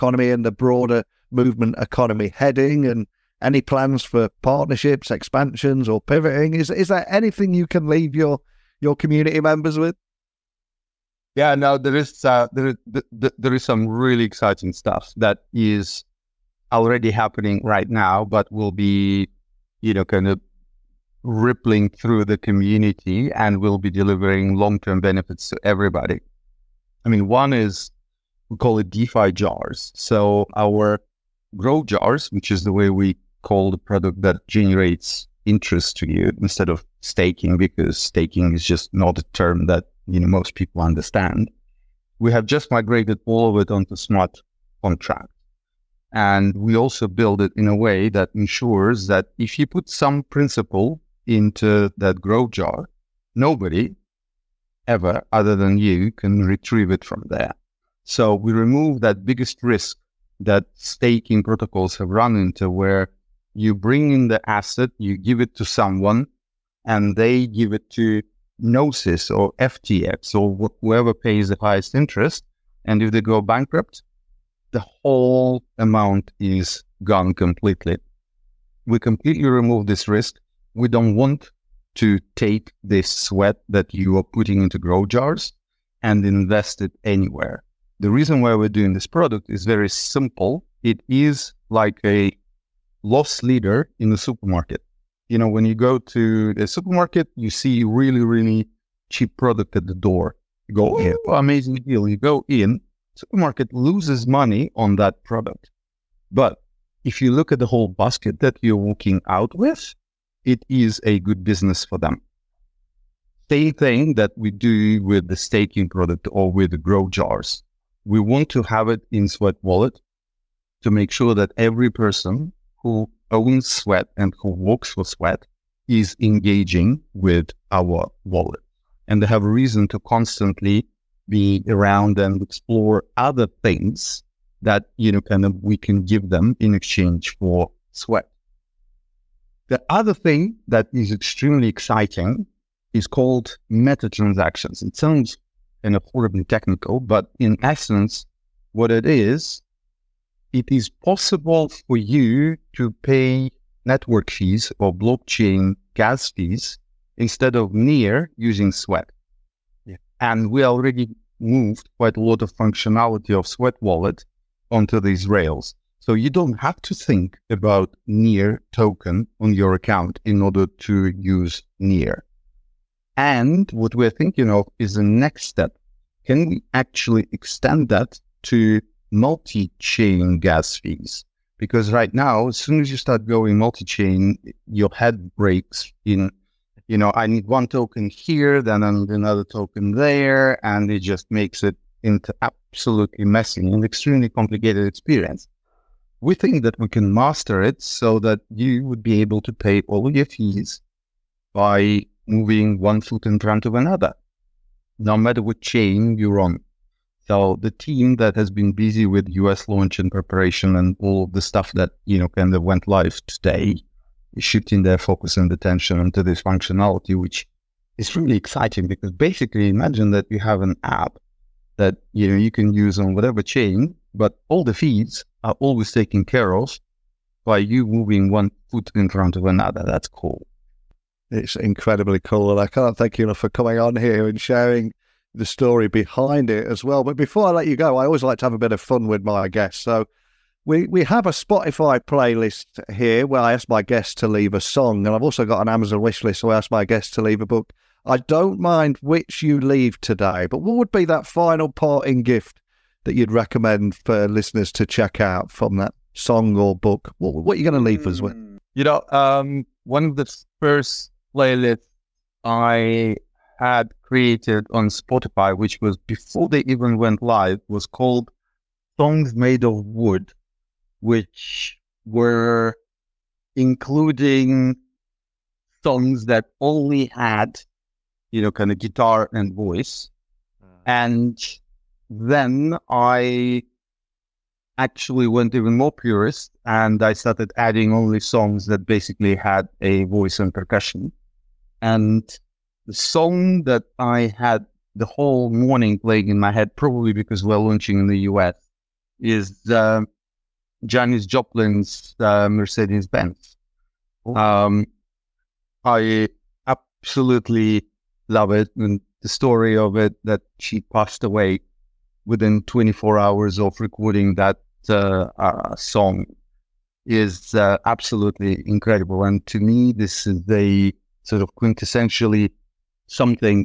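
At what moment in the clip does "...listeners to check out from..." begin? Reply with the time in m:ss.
4:14.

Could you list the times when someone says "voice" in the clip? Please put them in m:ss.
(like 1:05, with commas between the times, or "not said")
4:39, 4:50.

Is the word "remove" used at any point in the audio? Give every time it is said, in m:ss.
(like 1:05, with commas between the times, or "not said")
0:58, 1:19.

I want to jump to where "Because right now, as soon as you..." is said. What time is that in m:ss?
3:01.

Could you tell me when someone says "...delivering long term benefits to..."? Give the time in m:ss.
0:23.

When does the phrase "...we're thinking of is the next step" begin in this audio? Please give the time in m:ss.
2:53.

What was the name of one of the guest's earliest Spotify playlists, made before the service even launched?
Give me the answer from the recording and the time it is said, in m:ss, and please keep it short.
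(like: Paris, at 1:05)
Songs Made of Wood, at 4:28.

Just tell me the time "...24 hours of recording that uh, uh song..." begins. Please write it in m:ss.
5:12.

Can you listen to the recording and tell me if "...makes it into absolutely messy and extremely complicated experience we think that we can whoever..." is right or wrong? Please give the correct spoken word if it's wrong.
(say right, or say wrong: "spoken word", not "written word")
wrong: "master", not "whoever".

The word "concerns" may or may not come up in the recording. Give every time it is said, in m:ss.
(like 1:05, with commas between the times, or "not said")
not said.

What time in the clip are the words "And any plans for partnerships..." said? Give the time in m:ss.
0:02.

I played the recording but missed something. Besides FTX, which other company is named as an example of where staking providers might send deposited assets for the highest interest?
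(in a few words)
Gnosis.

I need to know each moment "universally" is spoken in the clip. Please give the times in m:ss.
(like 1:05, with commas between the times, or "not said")
not said.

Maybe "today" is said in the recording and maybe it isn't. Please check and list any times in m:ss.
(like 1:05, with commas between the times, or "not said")
3:33, 4:09.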